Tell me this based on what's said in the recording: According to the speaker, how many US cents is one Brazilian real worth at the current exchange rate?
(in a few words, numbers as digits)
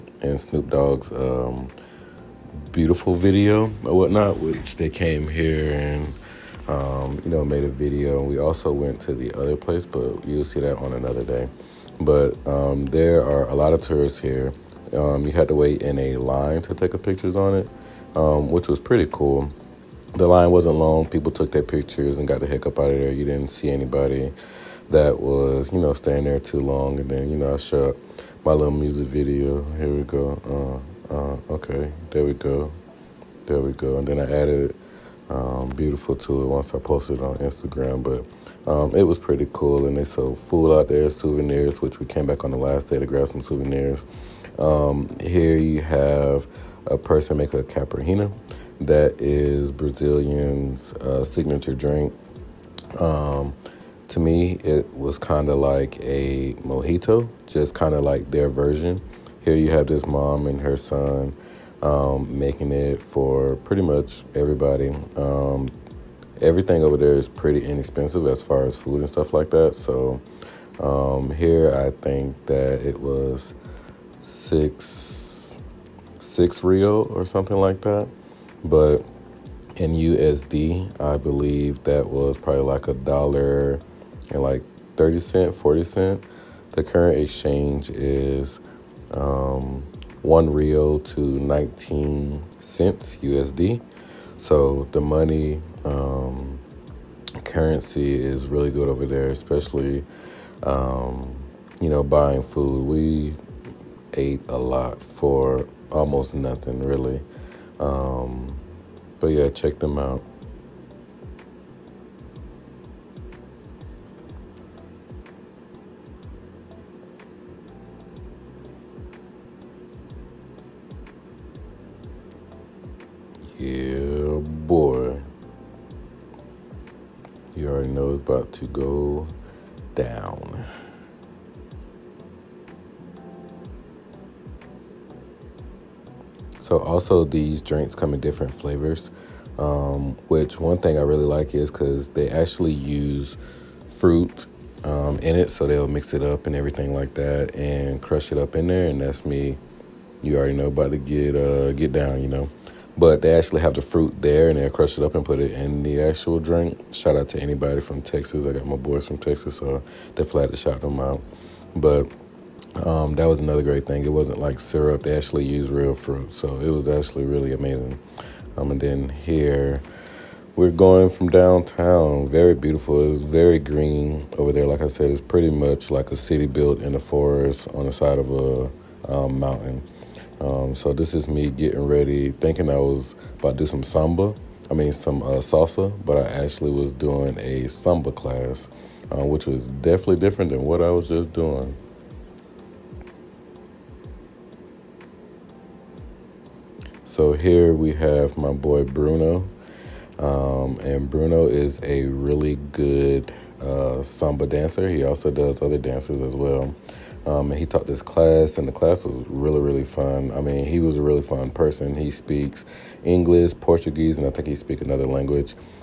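19 cents.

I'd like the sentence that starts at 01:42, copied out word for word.
We ate a lot for almost nothing, really.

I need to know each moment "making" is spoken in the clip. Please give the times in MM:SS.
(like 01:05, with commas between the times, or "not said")
01:02.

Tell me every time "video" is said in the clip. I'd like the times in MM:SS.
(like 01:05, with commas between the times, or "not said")
00:03, 00:07, 00:29.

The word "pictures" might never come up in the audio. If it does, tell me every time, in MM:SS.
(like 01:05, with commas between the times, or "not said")
00:16, 00:21.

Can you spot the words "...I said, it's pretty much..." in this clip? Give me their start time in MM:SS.
02:54.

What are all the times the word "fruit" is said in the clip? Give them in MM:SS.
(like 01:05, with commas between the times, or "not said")
02:23, 02:33, 02:45.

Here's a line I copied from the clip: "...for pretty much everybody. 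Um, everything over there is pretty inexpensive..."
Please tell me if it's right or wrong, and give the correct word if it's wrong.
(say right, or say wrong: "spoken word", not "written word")
right.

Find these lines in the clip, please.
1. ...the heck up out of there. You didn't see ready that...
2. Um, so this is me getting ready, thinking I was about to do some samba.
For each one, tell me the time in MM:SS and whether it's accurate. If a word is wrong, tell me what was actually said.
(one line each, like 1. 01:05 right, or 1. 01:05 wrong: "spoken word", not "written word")
1. 00:22 wrong: "anybody", not "ready"
2. 03:00 right.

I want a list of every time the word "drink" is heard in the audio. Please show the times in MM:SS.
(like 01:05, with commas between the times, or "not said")
00:51, 02:17, 02:36.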